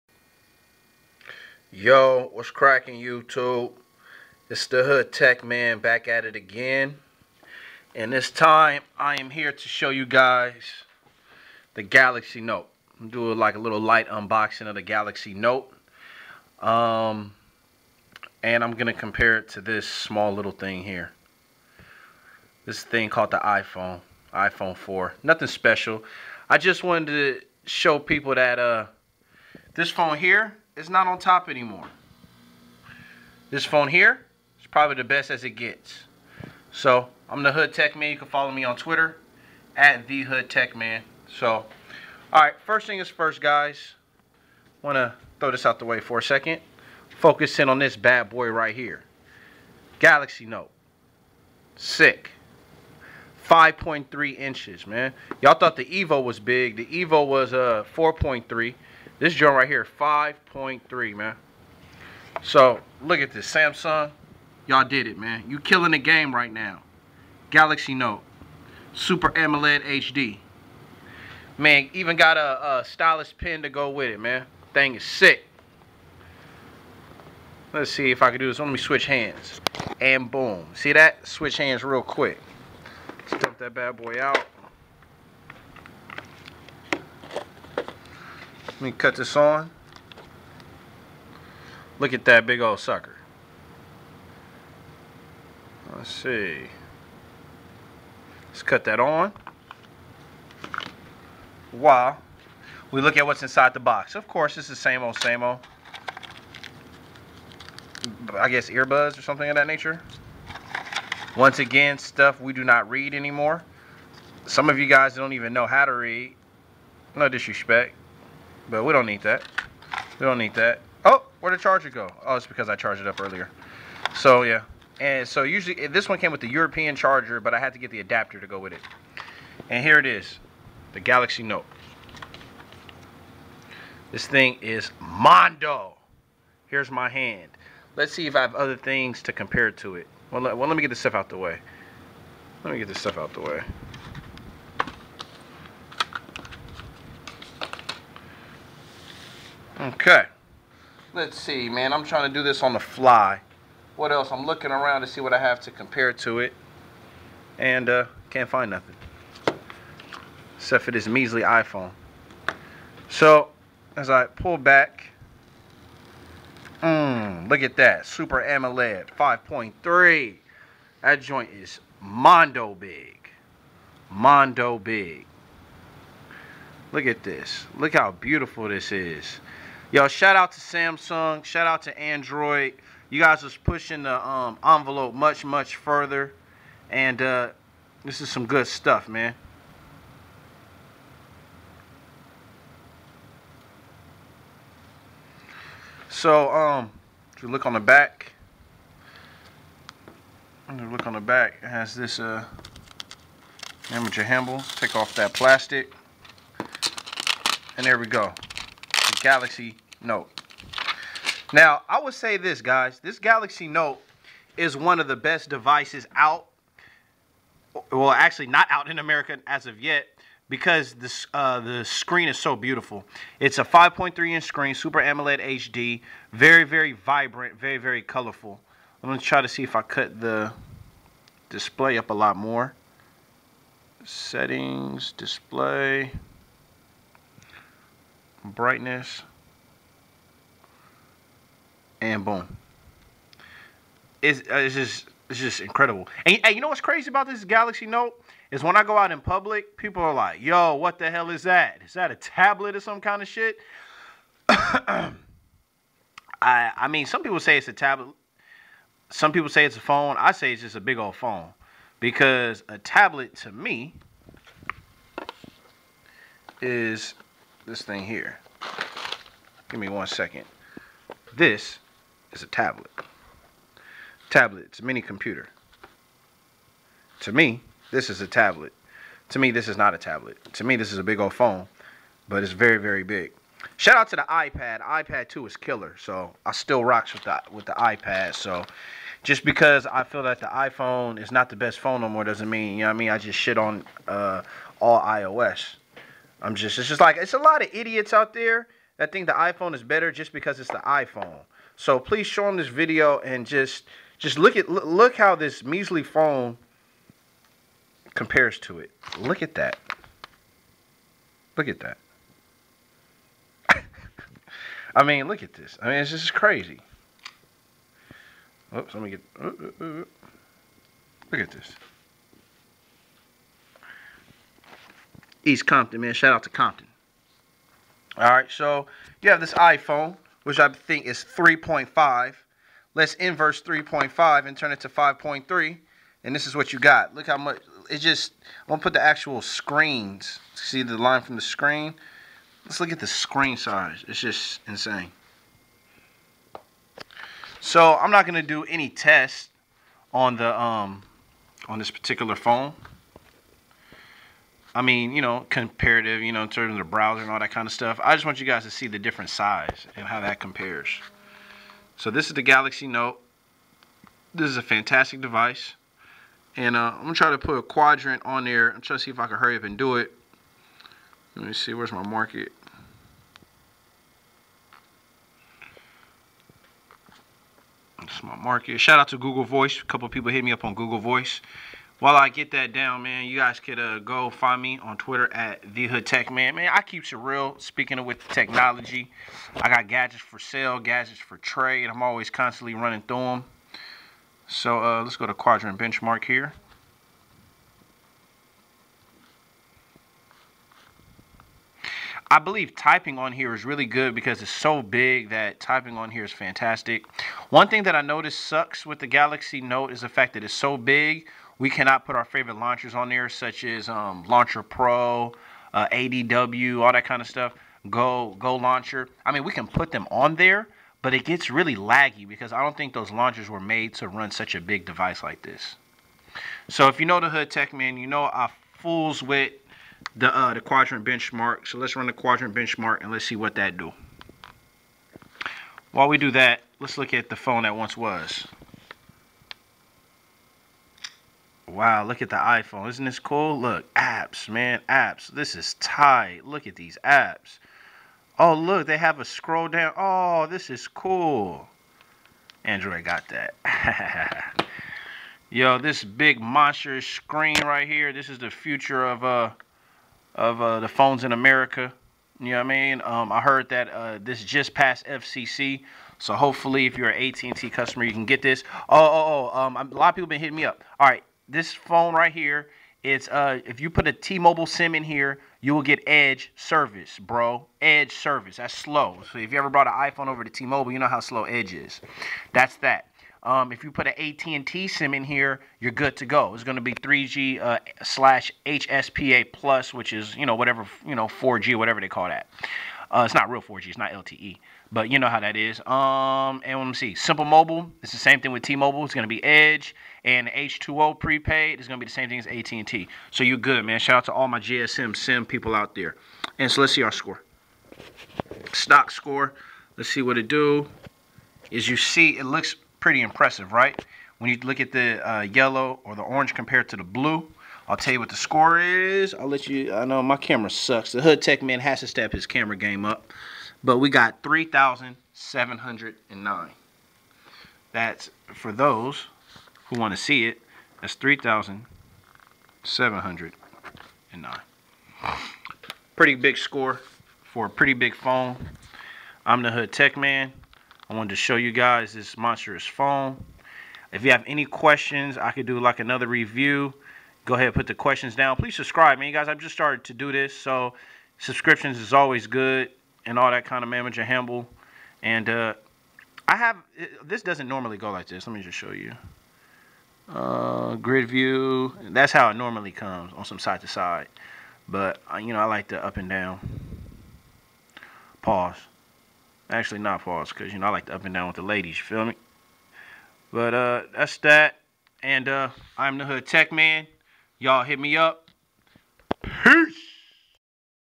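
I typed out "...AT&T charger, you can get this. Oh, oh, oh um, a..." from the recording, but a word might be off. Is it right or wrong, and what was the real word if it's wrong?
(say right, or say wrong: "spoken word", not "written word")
wrong: "customer", not "charger".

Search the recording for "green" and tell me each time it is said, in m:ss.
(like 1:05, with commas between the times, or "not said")
not said.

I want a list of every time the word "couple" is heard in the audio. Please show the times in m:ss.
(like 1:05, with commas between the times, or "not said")
6:19.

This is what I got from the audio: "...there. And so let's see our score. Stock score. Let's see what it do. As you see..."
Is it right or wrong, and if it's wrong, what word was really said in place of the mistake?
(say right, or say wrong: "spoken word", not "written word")
right.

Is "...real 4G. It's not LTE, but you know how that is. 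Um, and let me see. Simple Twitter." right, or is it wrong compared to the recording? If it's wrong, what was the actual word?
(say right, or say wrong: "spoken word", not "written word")
wrong: "Mobile", not "Twitter".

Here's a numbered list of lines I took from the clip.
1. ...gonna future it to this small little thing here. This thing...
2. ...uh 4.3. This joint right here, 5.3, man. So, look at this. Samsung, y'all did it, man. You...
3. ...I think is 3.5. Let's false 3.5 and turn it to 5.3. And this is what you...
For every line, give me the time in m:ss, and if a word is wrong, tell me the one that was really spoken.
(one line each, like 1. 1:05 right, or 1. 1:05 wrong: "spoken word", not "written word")
1. 0:18 wrong: "compare", not "future"
2. 0:57 right
3. 5:30 wrong: "inverse", not "false".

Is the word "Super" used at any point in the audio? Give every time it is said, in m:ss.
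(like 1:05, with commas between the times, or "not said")
1:08, 2:48, 3:44.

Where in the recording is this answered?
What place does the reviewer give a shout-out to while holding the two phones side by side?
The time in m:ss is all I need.
5:25.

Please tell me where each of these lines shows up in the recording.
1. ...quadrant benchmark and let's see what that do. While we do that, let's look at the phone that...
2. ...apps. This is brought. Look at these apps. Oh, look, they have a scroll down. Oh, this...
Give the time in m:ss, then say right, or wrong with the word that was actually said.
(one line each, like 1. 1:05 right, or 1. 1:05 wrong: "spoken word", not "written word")
1. 7:12 right
2. 7:24 wrong: "tight", not "brought".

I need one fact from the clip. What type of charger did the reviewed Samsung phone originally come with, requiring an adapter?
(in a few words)
European charger.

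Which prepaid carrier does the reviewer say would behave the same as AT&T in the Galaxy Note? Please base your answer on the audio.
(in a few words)
H2O.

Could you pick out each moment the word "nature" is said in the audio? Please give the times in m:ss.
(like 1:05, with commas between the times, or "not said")
1:49.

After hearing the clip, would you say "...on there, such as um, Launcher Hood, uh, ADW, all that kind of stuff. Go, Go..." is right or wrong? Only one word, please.
wrong.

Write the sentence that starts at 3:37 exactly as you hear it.
Well, actually, not out in America as of yet because this, uh, the screen is so beautiful.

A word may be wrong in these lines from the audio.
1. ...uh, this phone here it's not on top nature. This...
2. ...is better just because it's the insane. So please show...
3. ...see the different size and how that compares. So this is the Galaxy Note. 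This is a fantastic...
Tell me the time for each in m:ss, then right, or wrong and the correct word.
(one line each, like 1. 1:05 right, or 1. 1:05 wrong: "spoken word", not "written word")
1. 0:28 wrong: "anymore", not "nature"
2. 4:59 wrong: "iPhone", not "insane"
3. 5:58 right.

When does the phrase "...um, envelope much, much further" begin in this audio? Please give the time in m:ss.
3:04.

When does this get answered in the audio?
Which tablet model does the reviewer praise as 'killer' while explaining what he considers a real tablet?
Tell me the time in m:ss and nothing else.
4:44.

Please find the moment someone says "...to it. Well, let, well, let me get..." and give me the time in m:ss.
2:19.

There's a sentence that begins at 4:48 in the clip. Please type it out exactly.
So just because I feel that the iPhone is not the best phone no more doesn't mean, you know what I mean?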